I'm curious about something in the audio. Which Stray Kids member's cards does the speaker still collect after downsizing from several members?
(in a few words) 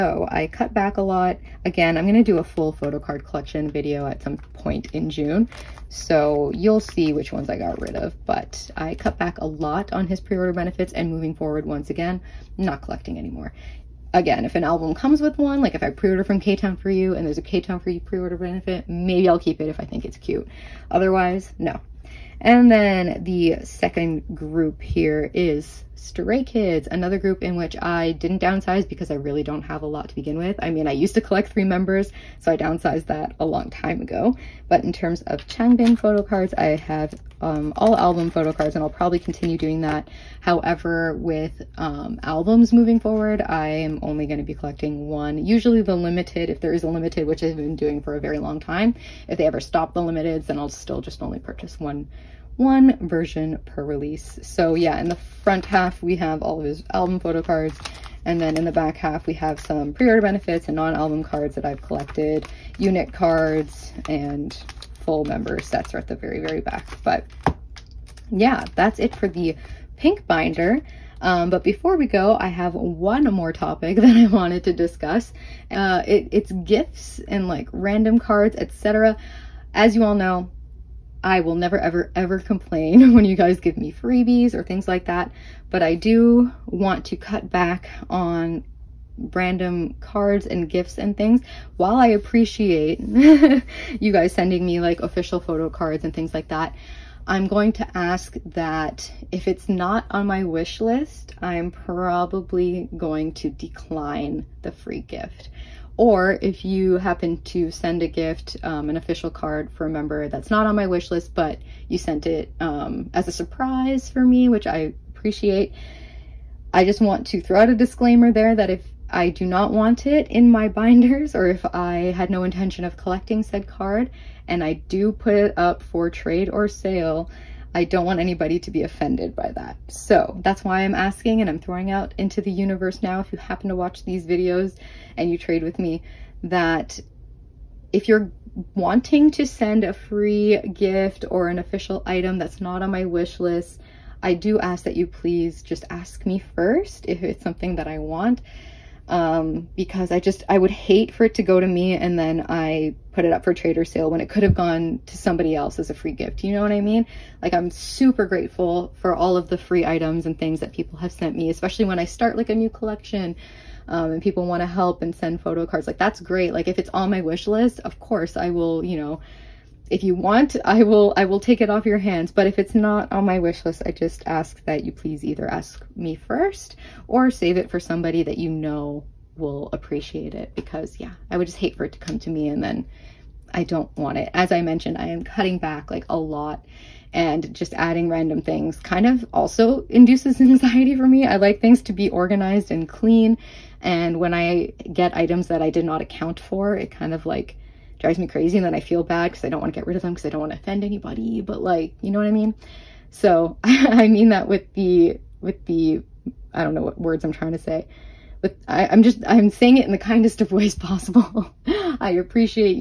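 Changbin.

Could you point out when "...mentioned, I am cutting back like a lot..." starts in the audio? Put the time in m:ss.
3:04.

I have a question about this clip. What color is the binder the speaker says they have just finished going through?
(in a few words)
Pink.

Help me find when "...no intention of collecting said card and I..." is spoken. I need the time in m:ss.
2:02.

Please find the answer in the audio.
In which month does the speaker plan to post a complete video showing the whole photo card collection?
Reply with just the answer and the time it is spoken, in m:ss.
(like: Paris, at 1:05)
June, at 0:05.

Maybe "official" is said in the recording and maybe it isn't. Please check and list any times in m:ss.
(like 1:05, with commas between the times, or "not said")
1:35, 1:48, 2:21.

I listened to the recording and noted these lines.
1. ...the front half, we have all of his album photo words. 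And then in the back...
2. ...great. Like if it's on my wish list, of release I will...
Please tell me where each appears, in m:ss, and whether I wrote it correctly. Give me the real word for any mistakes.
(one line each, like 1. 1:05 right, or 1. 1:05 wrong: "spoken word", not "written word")
1. 0:55 wrong: "cards", not "words"
2. 2:46 wrong: "course", not "release".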